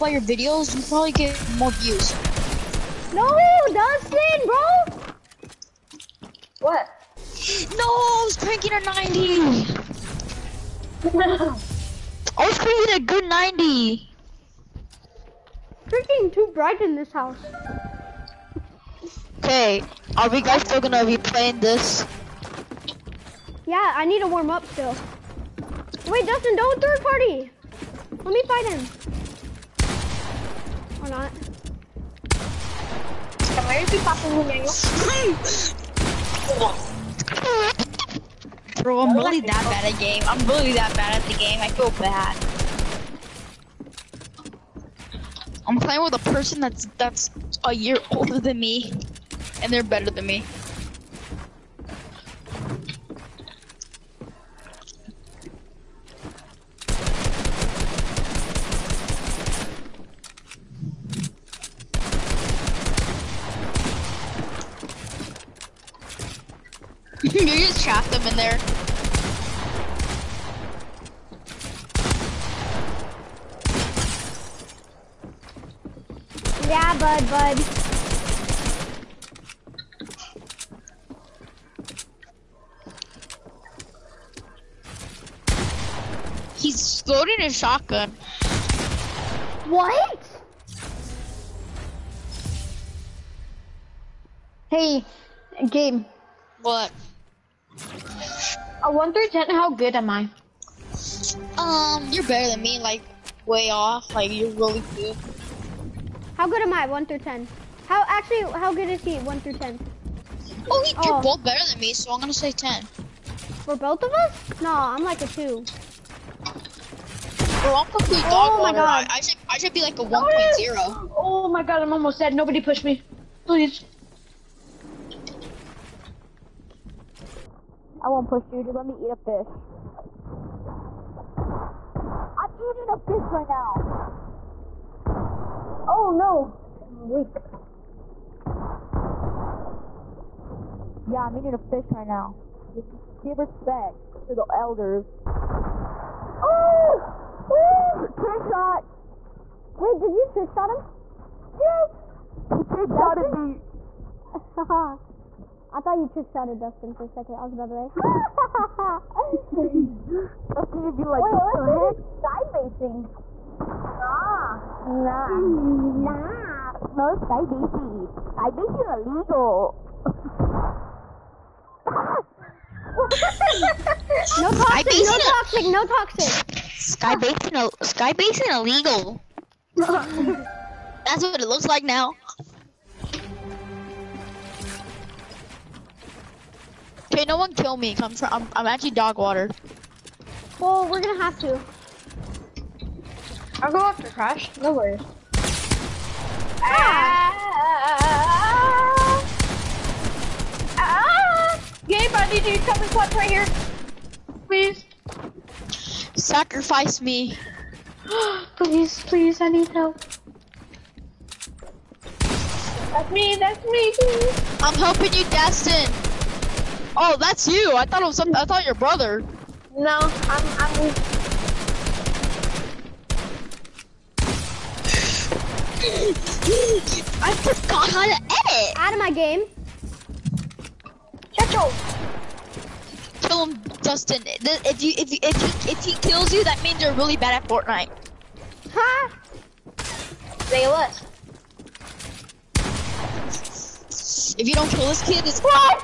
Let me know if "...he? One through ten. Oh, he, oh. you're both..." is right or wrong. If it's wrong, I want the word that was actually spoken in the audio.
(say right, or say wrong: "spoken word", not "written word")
right.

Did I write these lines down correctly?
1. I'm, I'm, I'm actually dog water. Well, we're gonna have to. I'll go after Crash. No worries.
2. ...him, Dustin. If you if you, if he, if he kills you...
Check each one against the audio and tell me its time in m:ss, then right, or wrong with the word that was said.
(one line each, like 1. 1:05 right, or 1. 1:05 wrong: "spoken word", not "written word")
1. 3:07 right
2. 3:53 right.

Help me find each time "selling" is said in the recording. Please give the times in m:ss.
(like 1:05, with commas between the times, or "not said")
not said.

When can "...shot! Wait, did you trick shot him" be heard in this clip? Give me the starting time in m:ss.
2:28.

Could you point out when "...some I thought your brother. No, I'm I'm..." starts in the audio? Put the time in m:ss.
3:38.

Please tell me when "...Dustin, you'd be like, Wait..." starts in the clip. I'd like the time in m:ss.
2:40.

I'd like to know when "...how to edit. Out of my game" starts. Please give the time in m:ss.
3:47.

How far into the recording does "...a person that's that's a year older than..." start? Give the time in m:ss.
0:46.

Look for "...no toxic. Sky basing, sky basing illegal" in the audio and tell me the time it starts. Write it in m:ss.
2:55.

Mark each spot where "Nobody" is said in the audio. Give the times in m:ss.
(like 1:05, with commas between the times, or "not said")
2:02.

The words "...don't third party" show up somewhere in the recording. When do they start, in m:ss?
0:26.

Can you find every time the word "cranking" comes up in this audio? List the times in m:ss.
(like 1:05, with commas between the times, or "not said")
0:08, 0:12.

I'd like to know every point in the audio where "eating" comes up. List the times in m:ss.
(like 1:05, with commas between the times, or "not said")
2:12, 2:21.